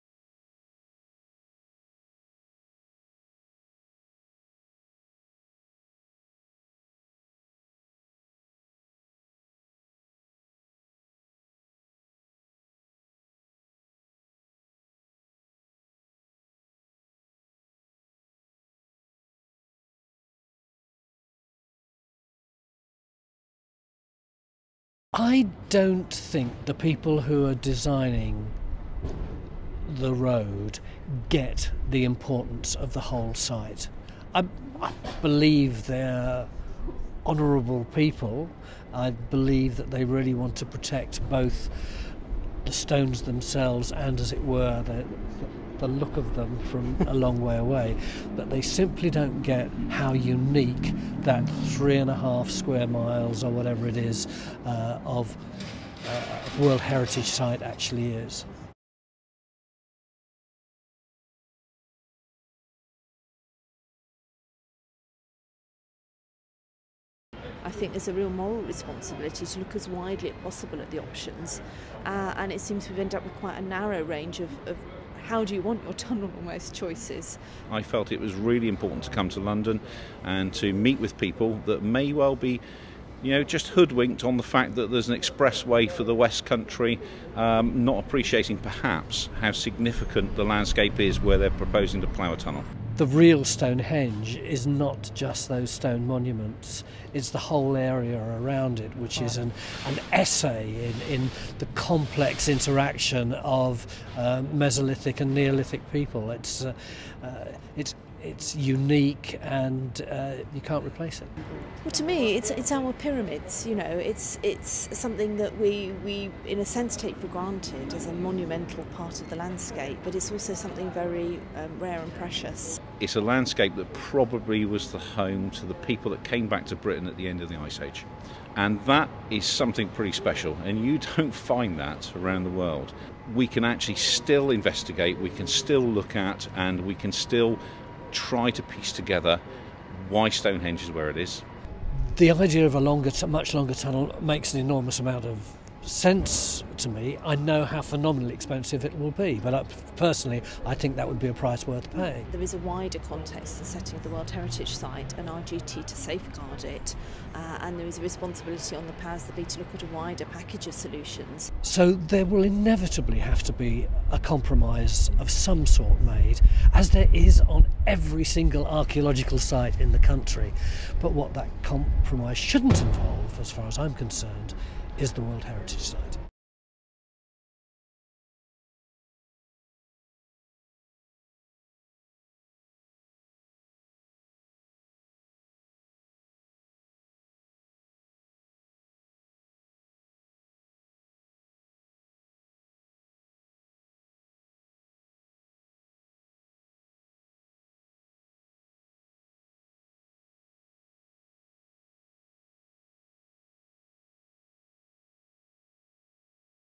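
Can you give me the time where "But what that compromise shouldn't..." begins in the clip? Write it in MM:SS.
02:51.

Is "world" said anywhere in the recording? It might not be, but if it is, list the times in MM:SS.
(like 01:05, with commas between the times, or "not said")
00:56, 02:12, 02:34, 02:55.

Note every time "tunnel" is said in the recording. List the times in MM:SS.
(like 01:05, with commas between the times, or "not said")
01:15, 01:32, 02:23.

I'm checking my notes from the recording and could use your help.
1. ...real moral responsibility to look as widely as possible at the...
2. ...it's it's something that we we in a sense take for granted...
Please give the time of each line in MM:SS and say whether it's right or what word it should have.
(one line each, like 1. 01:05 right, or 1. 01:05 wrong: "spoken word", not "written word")
1. 01:08 right
2. 01:53 right.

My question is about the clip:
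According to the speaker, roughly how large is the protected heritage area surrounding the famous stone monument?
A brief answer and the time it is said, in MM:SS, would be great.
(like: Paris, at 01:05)
3.5 square miles, at 00:51.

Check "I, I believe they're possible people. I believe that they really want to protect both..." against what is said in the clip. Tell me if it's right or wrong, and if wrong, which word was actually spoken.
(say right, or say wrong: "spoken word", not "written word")
wrong: "honourable", not "possible".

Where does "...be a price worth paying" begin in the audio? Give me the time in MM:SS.
02:31.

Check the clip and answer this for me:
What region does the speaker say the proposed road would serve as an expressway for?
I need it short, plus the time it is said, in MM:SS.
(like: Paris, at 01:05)
West Country, at 01:26.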